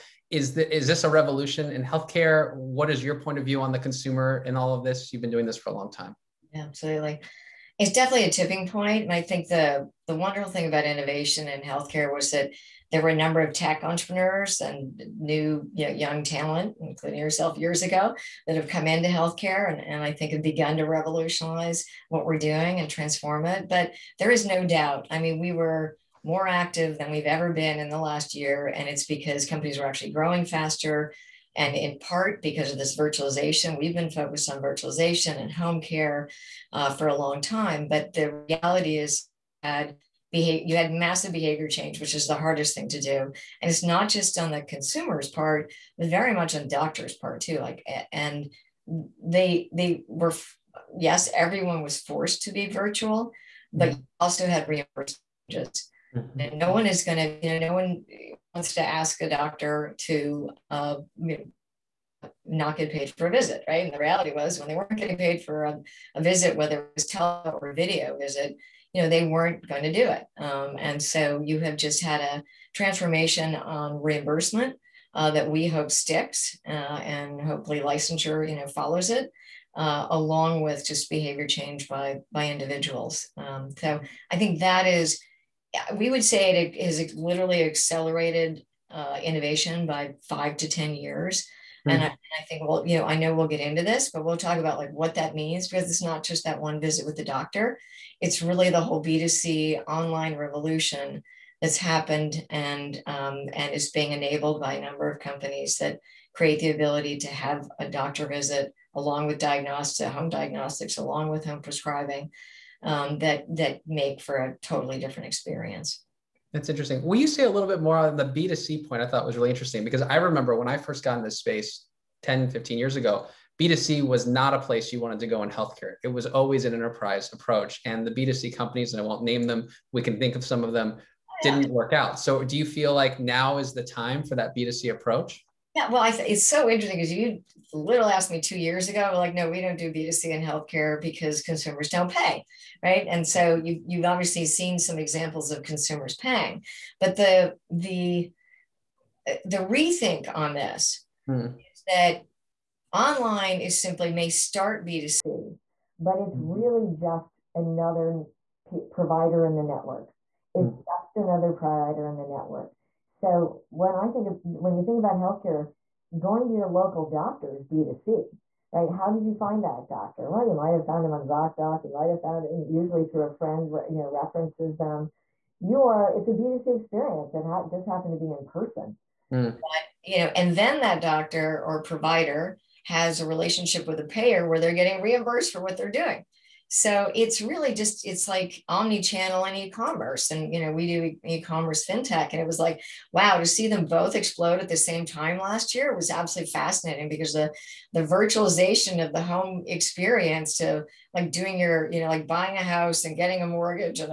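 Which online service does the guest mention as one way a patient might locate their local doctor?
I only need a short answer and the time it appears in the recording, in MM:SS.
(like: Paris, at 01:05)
ZocDoc, at 02:51.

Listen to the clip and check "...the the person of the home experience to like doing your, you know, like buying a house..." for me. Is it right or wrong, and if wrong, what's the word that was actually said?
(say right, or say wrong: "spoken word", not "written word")
wrong: "virtualization", not "person".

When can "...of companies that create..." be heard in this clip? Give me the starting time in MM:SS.
01:45.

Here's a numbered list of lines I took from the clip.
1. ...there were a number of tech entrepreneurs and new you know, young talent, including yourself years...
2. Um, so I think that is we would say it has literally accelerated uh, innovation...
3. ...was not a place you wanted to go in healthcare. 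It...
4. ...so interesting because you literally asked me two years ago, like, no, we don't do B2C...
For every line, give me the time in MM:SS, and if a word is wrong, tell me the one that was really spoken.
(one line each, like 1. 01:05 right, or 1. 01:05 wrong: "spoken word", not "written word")
1. 00:12 right
2. 01:23 right
3. 02:04 right
4. 02:16 right.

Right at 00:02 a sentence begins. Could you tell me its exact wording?
What is your point of view on the consumer in all of this?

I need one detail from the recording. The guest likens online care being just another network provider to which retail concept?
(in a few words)
omni-channel.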